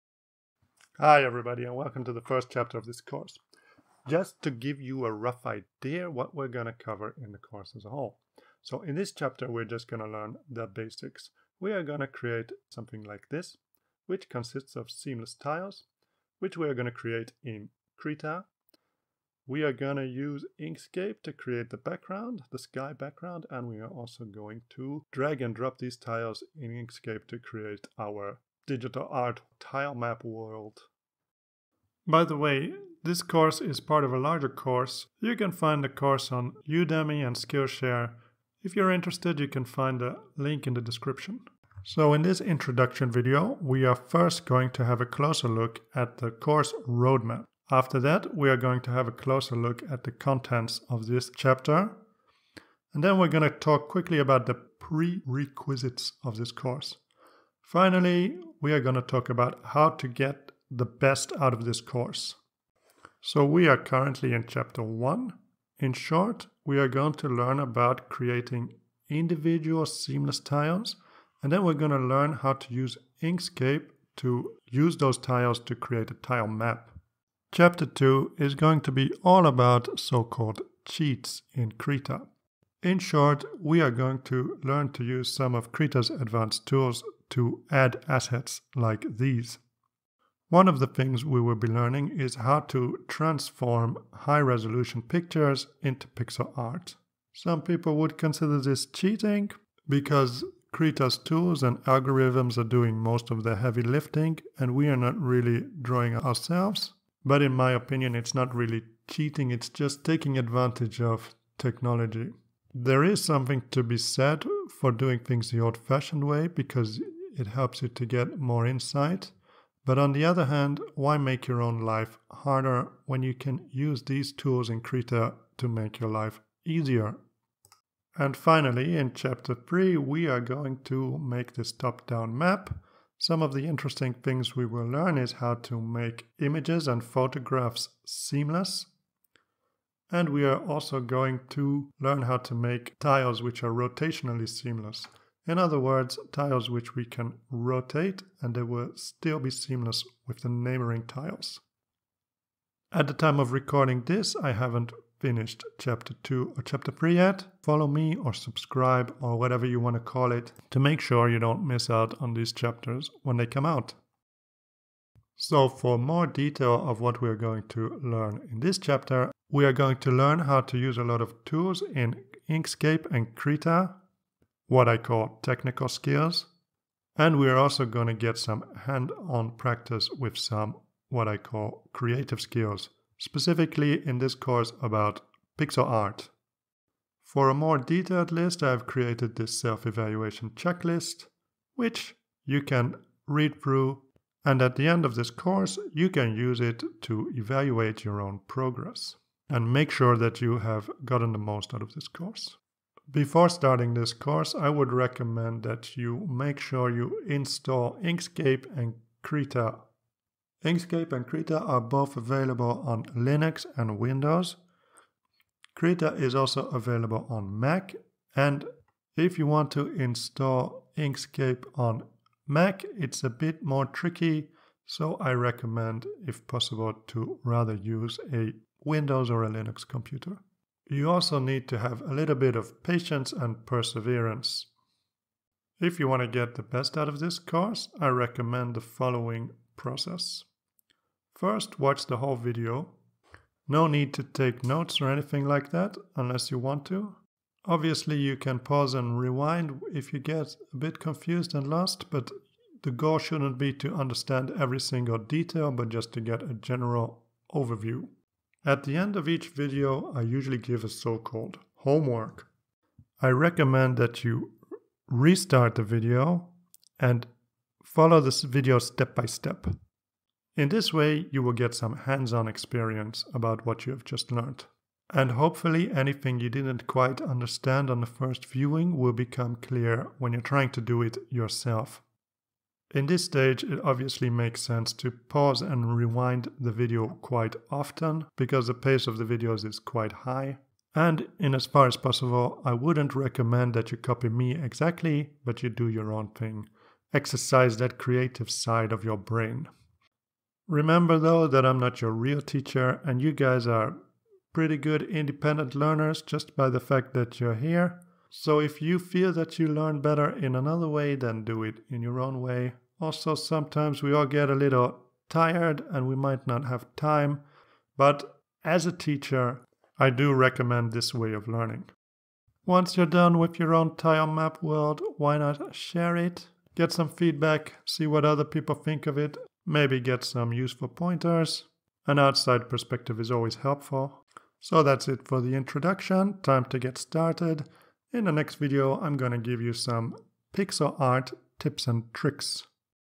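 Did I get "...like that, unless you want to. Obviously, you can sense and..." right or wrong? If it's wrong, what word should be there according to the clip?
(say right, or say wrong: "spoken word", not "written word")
wrong: "pause", not "sense".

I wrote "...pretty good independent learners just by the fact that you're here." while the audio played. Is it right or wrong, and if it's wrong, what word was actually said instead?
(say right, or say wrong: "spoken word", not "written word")
right.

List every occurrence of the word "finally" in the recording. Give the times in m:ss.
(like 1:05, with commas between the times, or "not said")
0:57, 2:08.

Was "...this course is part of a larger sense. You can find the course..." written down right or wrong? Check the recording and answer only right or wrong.
wrong.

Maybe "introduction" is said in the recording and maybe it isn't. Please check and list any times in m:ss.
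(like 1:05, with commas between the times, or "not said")
0:42, 5:35.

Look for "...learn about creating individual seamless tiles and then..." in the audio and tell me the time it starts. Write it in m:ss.
1:07.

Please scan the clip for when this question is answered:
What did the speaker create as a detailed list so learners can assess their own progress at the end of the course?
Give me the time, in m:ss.
3:09.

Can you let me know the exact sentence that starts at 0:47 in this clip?
After that, we are going to have a closer look at the contents of this chapter.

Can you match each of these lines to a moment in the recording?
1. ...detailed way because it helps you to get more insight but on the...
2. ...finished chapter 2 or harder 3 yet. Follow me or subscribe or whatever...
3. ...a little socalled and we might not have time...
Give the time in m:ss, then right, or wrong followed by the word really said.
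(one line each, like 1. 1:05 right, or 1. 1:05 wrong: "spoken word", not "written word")
1. 1:55 wrong: "fashioned", not "detailed"
2. 2:35 wrong: "chapter", not "harder"
3. 5:14 wrong: "tired", not "socalled".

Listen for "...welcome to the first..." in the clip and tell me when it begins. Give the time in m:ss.
0:01.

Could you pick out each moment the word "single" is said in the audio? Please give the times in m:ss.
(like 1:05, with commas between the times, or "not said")
4:14.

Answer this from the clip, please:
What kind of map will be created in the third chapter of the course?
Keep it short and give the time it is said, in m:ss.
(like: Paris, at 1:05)
top-down map, at 2:11.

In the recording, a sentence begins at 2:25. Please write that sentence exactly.
In other words, tiles which we can rotate and they will still be seamless with the neighboring tiles.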